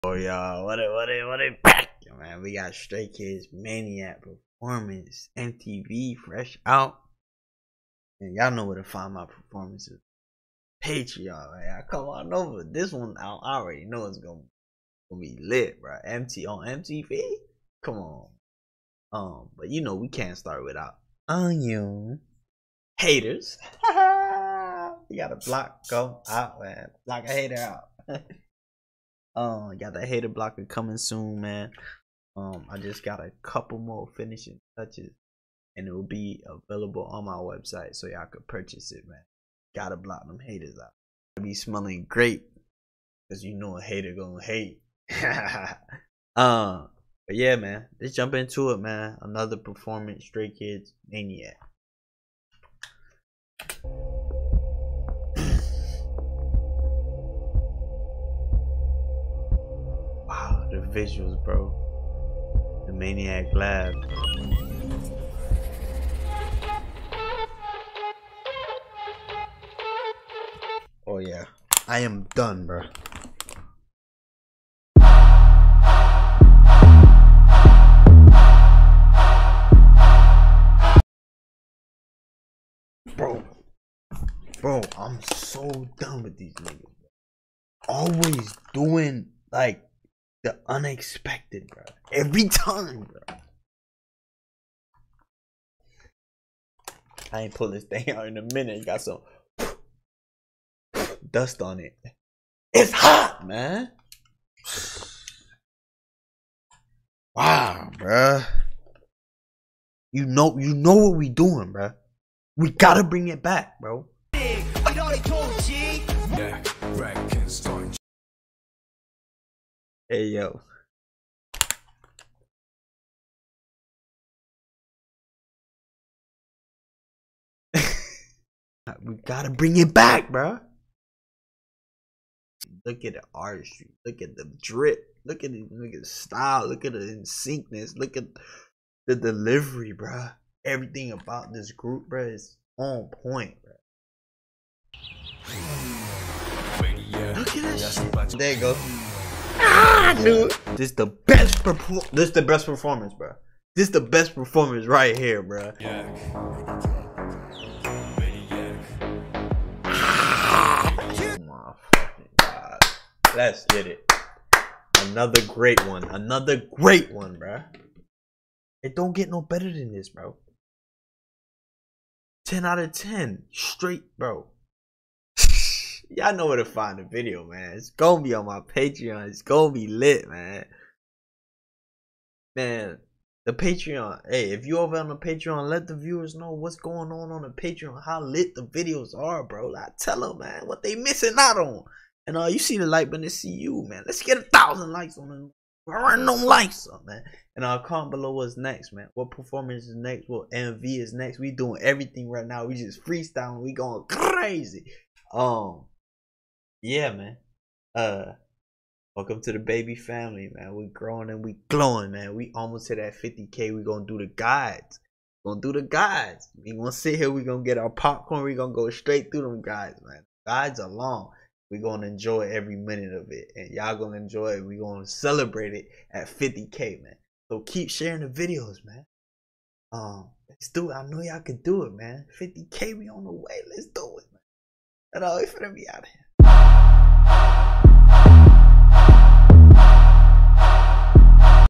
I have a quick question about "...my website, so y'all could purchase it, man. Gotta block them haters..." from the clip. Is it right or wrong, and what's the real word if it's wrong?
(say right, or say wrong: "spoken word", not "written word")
right.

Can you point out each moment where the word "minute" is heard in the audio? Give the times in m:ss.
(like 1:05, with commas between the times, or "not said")
1:38, 3:42.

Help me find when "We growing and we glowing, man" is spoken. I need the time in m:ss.
3:30.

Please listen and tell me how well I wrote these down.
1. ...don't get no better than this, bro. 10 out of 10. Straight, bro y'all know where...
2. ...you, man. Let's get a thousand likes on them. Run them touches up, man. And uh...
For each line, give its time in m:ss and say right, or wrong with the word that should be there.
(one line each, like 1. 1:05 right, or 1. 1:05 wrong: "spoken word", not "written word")
1. 2:48 right
2. 3:13 wrong: "likes", not "touches".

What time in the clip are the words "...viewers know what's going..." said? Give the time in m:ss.
3:05.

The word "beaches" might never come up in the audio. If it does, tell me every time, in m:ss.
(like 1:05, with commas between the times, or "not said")
not said.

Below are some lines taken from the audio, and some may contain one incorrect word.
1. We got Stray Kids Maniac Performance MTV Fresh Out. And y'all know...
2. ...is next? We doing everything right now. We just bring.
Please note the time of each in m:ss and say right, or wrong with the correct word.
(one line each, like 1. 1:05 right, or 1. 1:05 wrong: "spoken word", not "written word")
1. 0:02 right
2. 3:20 wrong: "freestyling", not "bring".